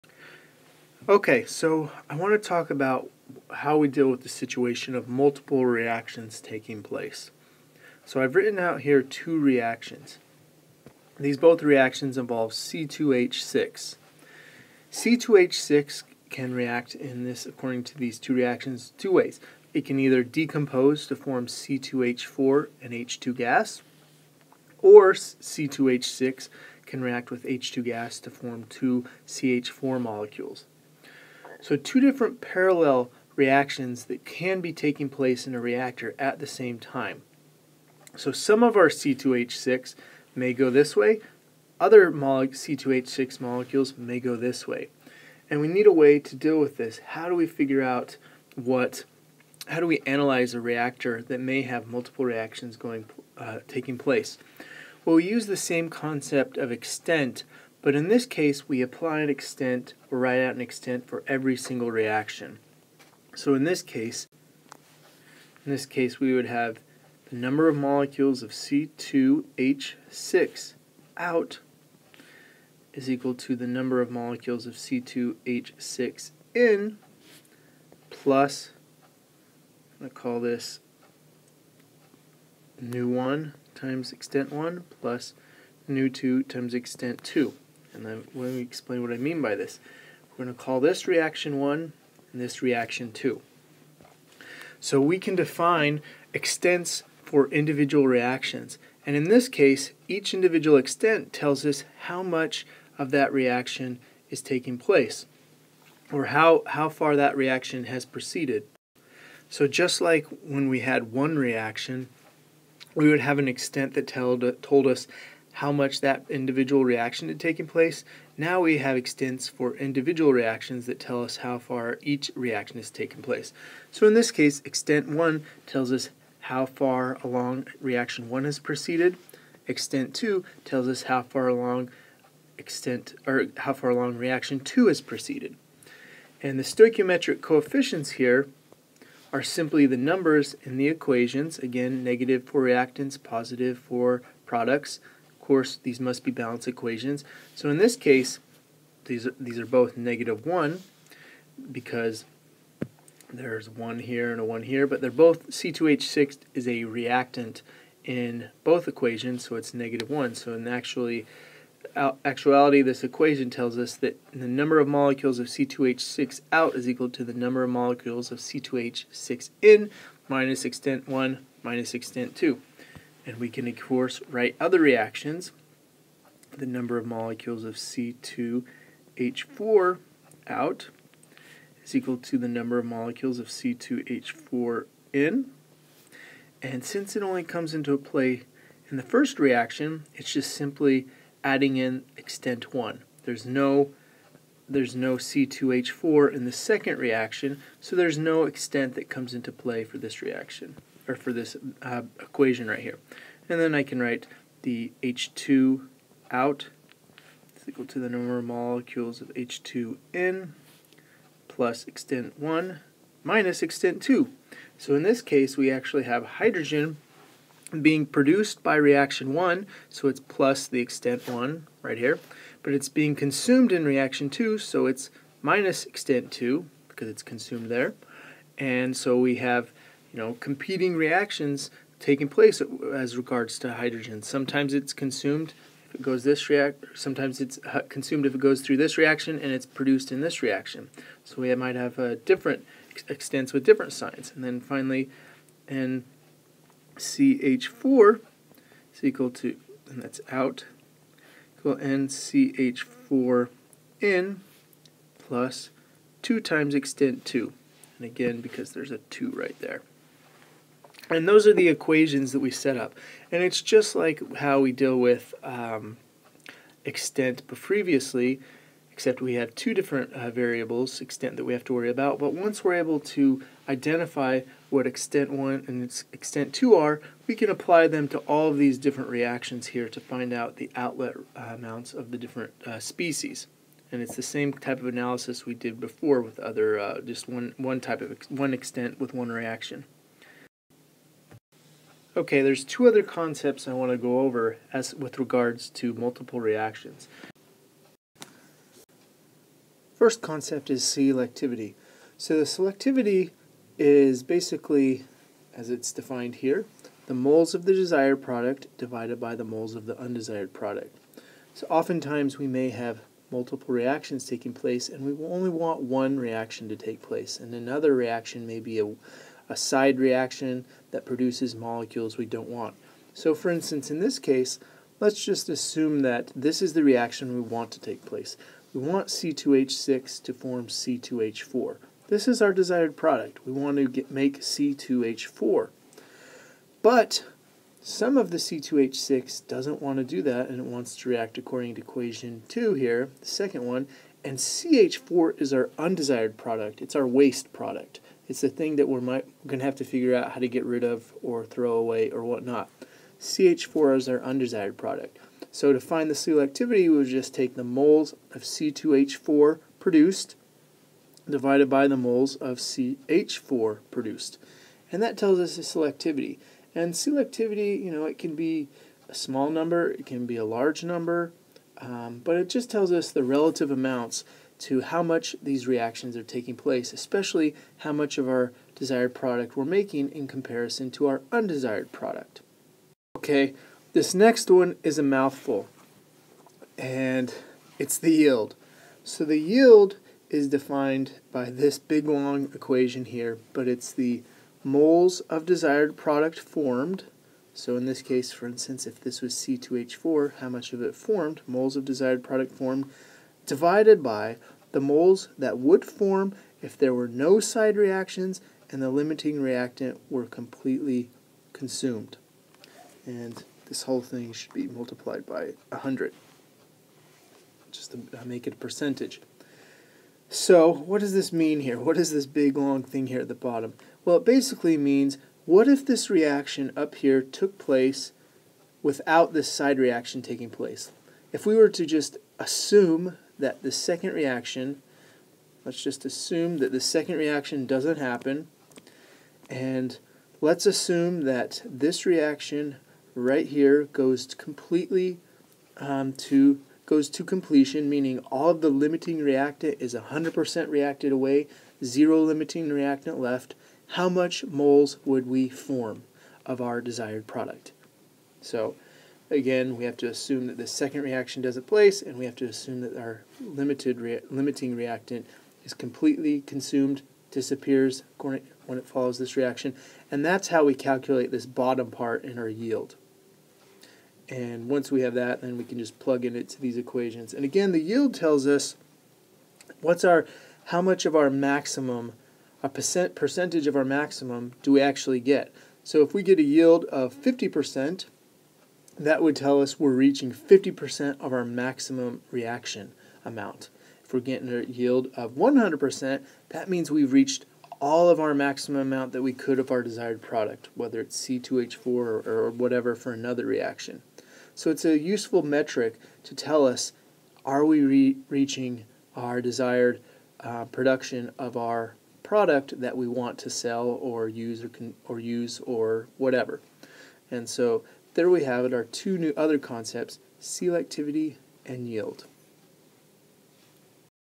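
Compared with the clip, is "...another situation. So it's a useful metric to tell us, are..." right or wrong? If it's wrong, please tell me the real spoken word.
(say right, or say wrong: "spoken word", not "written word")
wrong: "reaction", not "situation".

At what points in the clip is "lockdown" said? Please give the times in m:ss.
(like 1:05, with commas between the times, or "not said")
not said.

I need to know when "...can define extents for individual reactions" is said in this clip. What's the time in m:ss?
1:35.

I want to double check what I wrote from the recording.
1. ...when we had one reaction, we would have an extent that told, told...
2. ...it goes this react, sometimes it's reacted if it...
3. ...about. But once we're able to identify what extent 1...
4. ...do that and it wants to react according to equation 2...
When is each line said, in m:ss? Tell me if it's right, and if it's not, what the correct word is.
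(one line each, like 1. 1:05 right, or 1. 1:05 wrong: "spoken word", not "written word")
1. 1:50 right
2. 3:55 wrong: "consumed", not "reacted"
3. 4:31 right
4. 5:40 right.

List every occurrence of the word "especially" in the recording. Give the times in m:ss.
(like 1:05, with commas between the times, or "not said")
6:16.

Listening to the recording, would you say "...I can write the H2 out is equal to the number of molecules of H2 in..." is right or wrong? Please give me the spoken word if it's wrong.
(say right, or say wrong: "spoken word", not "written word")
right.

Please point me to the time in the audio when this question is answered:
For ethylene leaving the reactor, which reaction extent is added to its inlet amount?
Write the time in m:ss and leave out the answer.
3:11.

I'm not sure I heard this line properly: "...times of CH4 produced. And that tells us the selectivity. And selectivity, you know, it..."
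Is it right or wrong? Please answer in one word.
wrong.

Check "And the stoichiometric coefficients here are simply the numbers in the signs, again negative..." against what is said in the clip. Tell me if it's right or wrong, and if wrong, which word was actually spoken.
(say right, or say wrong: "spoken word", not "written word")
wrong: "equations", not "signs".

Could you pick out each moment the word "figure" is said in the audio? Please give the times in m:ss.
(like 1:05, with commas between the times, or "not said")
0:47, 5:49.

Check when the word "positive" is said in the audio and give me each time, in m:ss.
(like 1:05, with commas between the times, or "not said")
2:23.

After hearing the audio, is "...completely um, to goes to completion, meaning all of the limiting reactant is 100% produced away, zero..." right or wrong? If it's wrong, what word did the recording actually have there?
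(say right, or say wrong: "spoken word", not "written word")
wrong: "reacted", not "produced".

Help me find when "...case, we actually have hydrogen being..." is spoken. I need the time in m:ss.
3:35.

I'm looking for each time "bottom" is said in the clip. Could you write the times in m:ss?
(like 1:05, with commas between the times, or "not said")
7:03, 7:51.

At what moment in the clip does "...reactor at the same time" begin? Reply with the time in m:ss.
0:35.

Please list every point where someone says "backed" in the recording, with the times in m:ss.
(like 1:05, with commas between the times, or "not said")
not said.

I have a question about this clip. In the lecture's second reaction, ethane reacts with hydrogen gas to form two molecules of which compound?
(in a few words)
CH4.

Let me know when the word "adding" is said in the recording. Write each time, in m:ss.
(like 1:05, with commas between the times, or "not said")
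3:11.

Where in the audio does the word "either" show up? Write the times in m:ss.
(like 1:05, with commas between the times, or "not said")
0:19.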